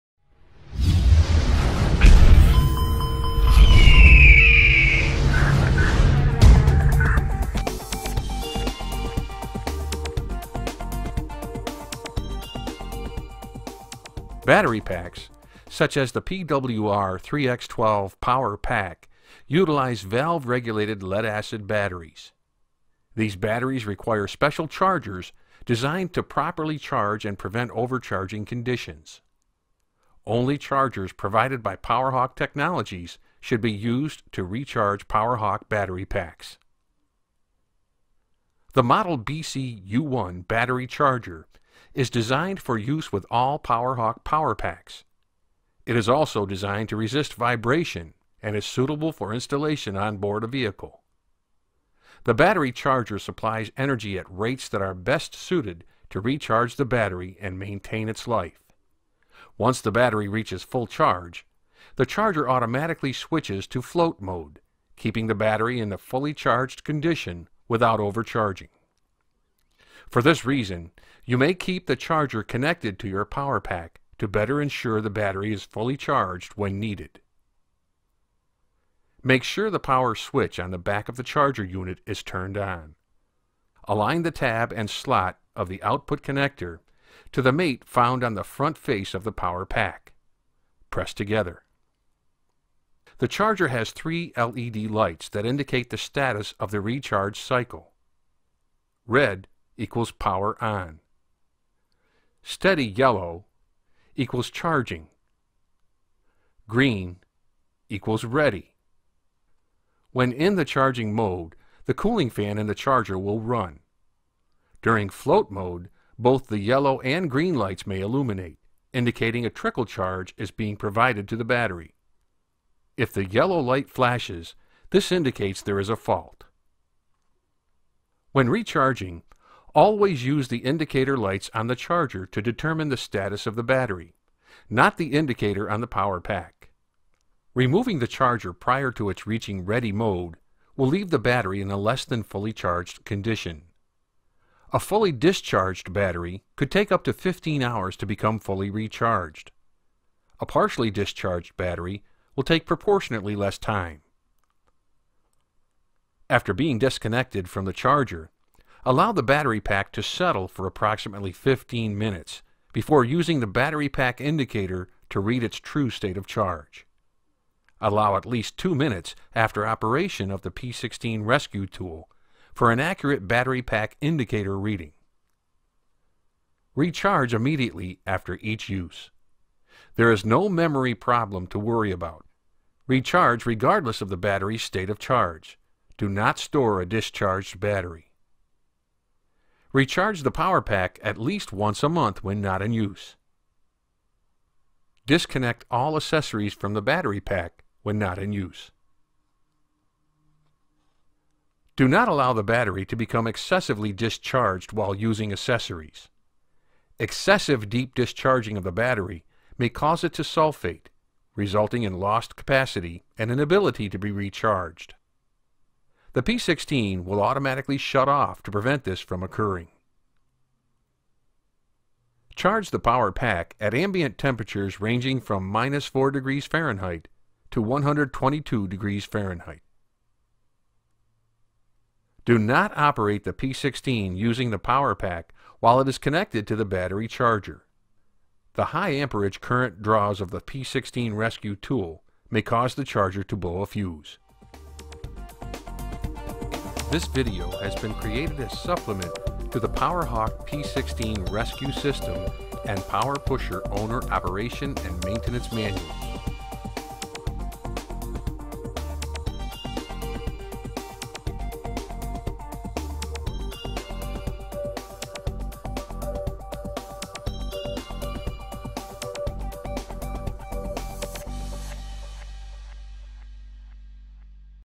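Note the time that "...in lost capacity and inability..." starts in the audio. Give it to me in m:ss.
3:31.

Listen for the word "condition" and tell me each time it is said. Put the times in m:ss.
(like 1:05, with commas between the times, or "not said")
0:28, 1:06, 2:23.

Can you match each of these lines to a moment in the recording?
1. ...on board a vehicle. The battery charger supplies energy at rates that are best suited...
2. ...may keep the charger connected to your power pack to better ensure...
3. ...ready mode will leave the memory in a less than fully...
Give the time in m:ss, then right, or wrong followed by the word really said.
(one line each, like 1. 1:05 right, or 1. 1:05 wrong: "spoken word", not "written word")
1. 0:49 right
2. 1:11 right
3. 2:19 wrong: "battery", not "memory".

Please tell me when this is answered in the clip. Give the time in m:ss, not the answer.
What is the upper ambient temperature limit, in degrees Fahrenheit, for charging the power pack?
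3:47.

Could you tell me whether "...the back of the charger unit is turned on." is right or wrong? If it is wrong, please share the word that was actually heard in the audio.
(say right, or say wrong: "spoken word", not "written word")
right.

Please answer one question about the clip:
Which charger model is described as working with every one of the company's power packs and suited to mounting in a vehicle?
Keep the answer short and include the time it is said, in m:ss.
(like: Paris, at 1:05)
Model BC U1, at 0:38.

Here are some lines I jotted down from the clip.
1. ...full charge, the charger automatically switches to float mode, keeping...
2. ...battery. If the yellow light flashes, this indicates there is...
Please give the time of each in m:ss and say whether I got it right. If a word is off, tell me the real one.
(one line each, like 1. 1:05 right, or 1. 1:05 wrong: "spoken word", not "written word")
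1. 1:00 right
2. 2:01 right.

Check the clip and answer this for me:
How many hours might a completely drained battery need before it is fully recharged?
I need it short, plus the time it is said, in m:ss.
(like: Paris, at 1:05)
15, at 2:27.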